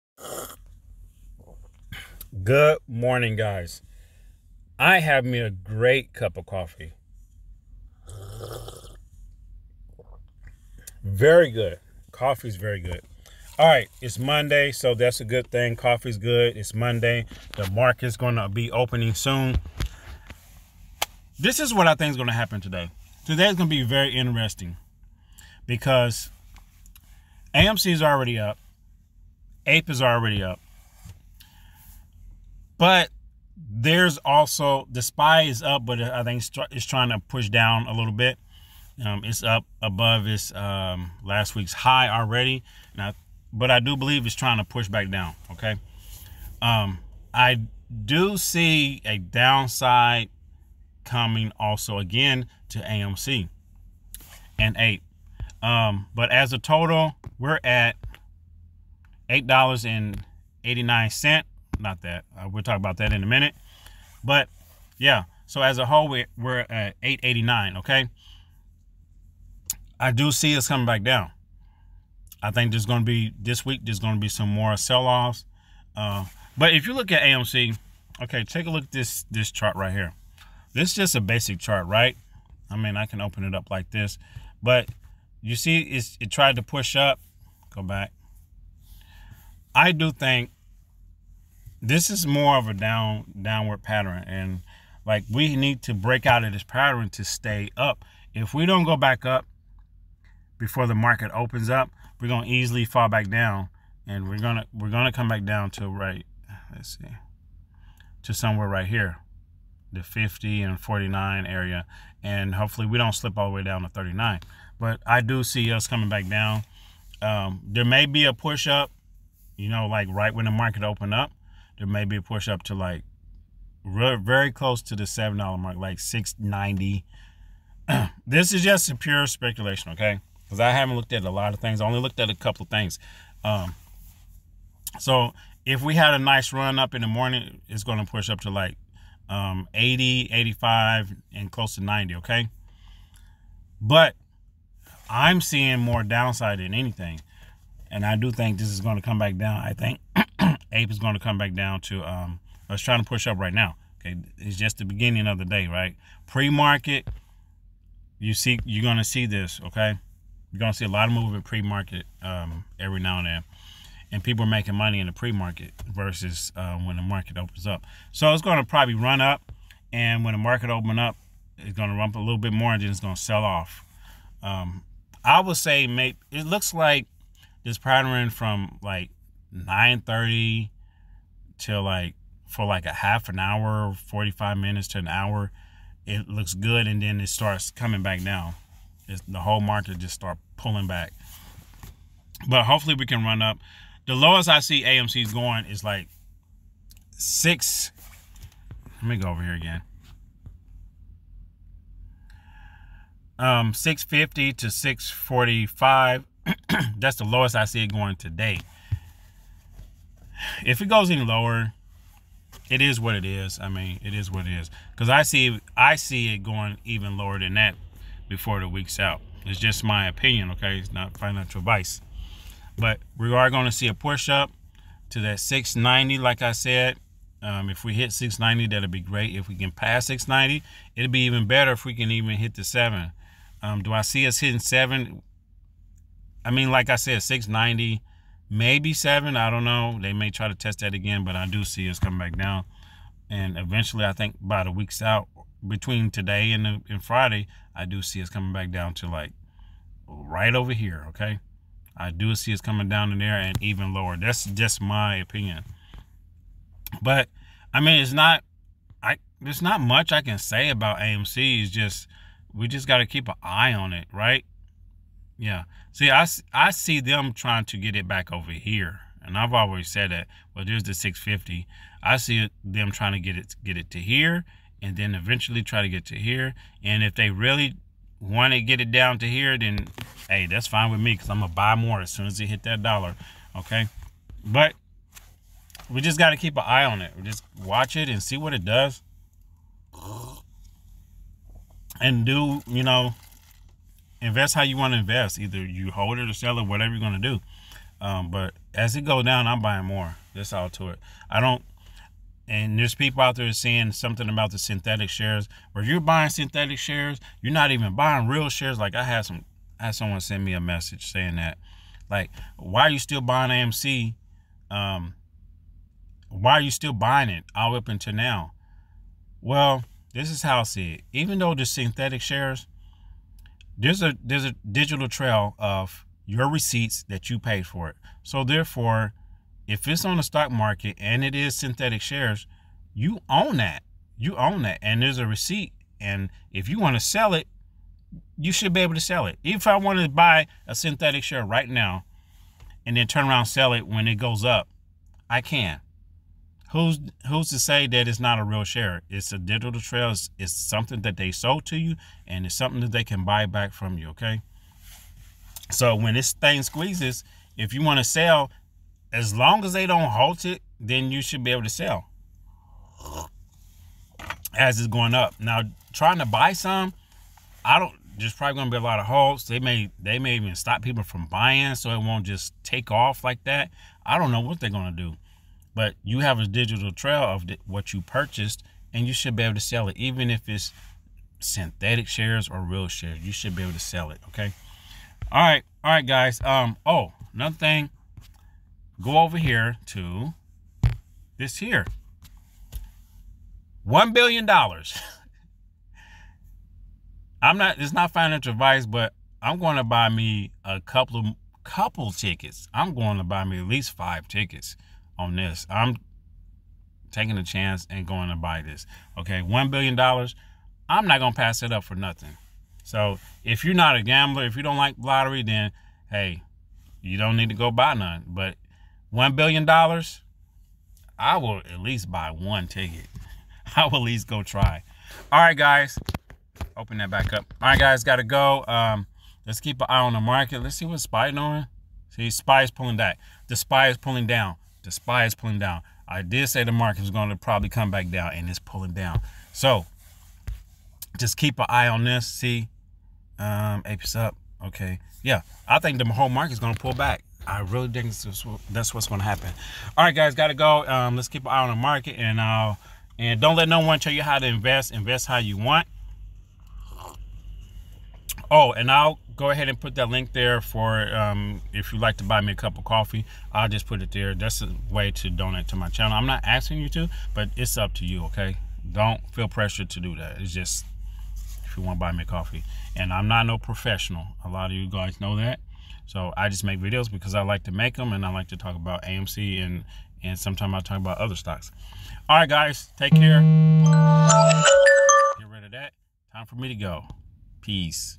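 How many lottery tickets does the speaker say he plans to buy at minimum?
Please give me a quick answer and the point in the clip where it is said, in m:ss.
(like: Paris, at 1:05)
5, at 6:43.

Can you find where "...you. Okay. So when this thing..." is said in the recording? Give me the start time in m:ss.
5:53.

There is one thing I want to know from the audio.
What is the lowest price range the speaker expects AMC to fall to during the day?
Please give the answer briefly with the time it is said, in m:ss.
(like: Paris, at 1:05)
650 to 645, at 3:23.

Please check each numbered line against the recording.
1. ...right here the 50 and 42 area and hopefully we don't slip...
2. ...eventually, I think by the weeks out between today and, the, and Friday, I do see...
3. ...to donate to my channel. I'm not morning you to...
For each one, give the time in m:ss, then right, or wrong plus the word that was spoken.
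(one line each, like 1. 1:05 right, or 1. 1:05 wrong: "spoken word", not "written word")
1. 1:48 wrong: "49", not "42"
2. 4:03 right
3. 7:45 wrong: "asking", not "morning".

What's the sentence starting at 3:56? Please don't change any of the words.
I mean, like I said, 690 maybe seven.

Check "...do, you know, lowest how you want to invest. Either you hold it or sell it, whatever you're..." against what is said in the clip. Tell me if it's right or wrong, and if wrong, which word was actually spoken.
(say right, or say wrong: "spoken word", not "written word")
wrong: "invest", not "lowest".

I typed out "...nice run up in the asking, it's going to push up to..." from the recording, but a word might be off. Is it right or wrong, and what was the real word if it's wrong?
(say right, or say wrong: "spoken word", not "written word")
wrong: "morning", not "asking".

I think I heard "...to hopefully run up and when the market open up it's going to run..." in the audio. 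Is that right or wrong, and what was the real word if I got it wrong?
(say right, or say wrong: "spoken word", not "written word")
wrong: "probably", not "hopefully".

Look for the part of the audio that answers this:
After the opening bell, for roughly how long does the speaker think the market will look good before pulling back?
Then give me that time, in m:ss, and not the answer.
3:04.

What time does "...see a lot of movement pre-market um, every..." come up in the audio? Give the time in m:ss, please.
2:40.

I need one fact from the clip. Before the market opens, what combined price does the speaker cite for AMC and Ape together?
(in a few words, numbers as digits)
$8.89.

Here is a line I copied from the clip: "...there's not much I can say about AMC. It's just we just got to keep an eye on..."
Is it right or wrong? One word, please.
right.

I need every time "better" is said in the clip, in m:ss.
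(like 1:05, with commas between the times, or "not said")
3:51.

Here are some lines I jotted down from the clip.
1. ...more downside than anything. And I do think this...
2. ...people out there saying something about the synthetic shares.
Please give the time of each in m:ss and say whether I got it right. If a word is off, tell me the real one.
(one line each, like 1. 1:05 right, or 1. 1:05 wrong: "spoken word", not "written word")
1. 2:25 right
2. 5:02 right.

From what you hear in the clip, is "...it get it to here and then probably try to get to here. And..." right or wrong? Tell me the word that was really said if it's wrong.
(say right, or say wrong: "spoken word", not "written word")
wrong: "eventually", not "probably".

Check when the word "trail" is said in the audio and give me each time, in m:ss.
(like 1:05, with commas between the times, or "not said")
5:25, 5:49, 6:16.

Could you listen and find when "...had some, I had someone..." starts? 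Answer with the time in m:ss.
5:09.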